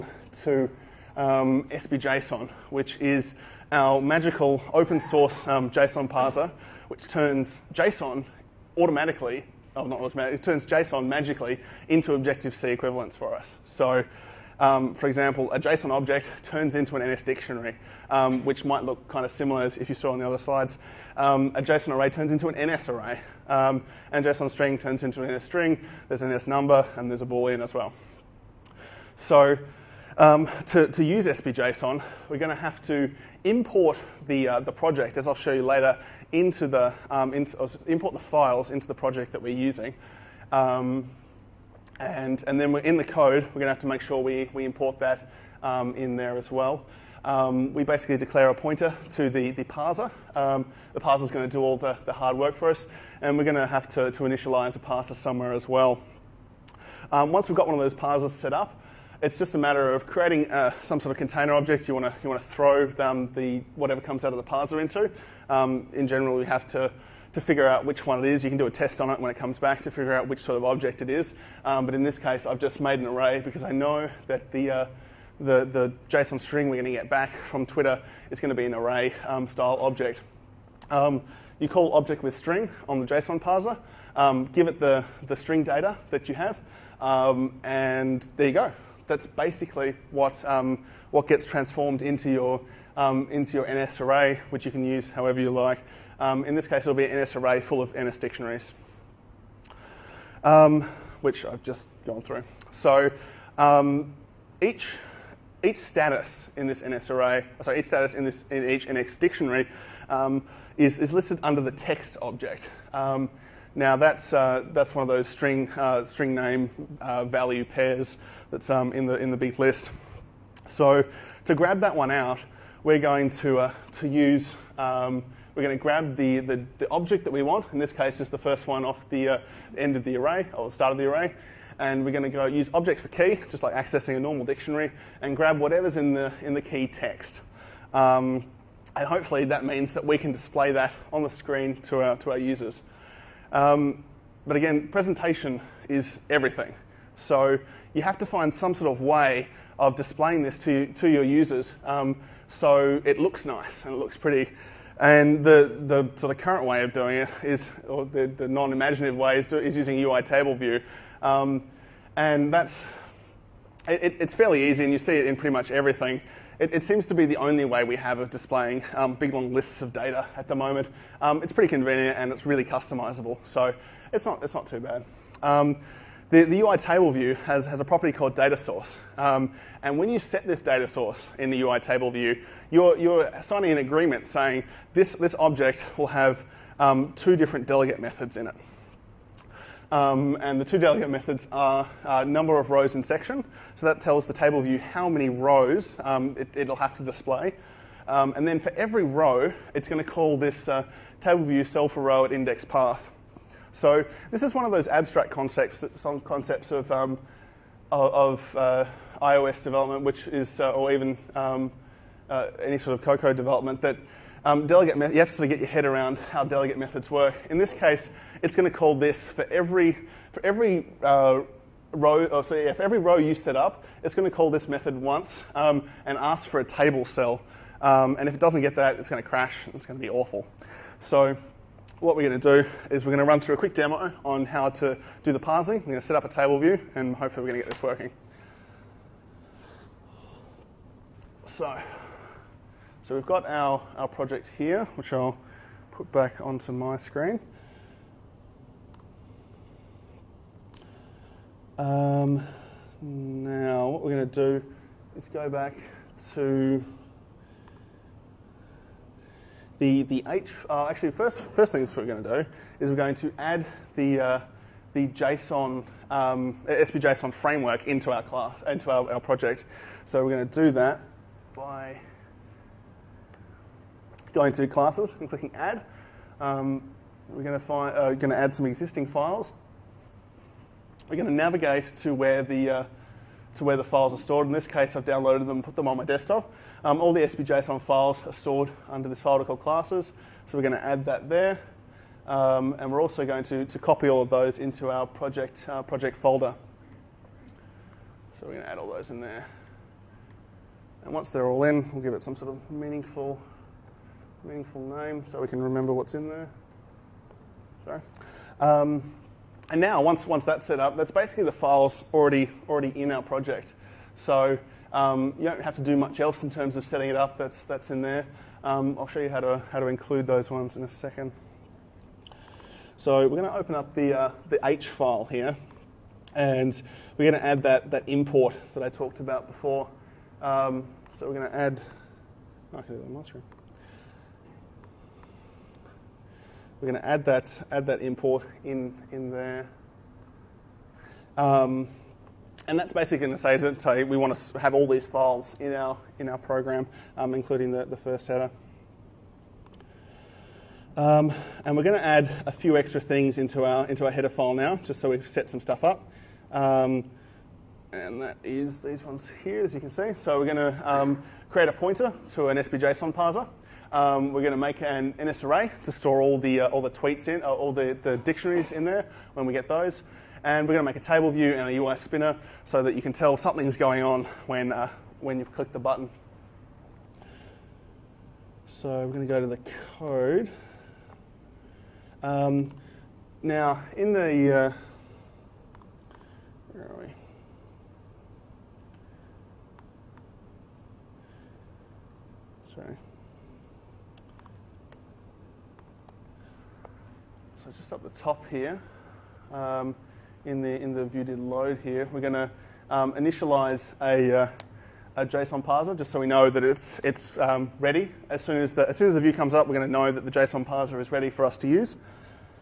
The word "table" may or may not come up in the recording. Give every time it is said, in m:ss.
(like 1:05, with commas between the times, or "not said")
2:40, 2:56, 3:01, 3:14, 3:21, 3:46, 3:56, 6:10.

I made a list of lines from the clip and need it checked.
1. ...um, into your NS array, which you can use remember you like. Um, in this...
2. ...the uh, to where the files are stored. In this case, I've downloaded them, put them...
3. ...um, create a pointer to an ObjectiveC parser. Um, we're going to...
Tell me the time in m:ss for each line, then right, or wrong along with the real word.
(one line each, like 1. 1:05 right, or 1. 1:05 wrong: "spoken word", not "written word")
1. 1:32 wrong: "however", not "remember"
2. 4:42 right
3. 6:00 wrong: "SBJSON", not "ObjectiveC".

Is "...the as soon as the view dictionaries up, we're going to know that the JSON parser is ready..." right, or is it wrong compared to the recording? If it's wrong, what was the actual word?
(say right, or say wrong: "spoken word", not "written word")
wrong: "comes", not "dictionaries".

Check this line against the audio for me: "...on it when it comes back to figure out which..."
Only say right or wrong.
right.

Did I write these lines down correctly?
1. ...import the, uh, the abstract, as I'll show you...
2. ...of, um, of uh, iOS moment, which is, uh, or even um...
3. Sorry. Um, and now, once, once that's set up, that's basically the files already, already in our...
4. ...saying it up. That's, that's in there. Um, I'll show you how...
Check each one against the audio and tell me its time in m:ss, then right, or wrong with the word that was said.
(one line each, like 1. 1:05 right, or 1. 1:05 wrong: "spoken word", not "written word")
1. 0:33 wrong: "project", not "abstract"
2. 3:26 wrong: "development", not "moment"
3. 5:07 right
4. 5:16 wrong: "setting", not "saying".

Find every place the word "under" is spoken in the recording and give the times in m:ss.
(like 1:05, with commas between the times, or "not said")
1:51, 4:48.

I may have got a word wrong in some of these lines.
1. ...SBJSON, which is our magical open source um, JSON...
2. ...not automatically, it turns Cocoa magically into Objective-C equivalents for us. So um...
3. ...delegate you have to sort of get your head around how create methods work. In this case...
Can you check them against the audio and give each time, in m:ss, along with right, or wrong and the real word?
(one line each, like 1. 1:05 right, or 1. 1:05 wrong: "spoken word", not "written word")
1. 0:01 right
2. 0:09 wrong: "JSON", not "Cocoa"
3. 3:34 wrong: "delegate", not "create".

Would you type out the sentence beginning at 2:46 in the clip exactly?
It, it seems to be the only way we have of displaying um, big long lists of data at the moment.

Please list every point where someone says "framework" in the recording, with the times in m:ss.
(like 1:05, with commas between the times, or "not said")
4:27.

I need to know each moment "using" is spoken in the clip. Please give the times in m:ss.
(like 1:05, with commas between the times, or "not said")
0:39, 2:39.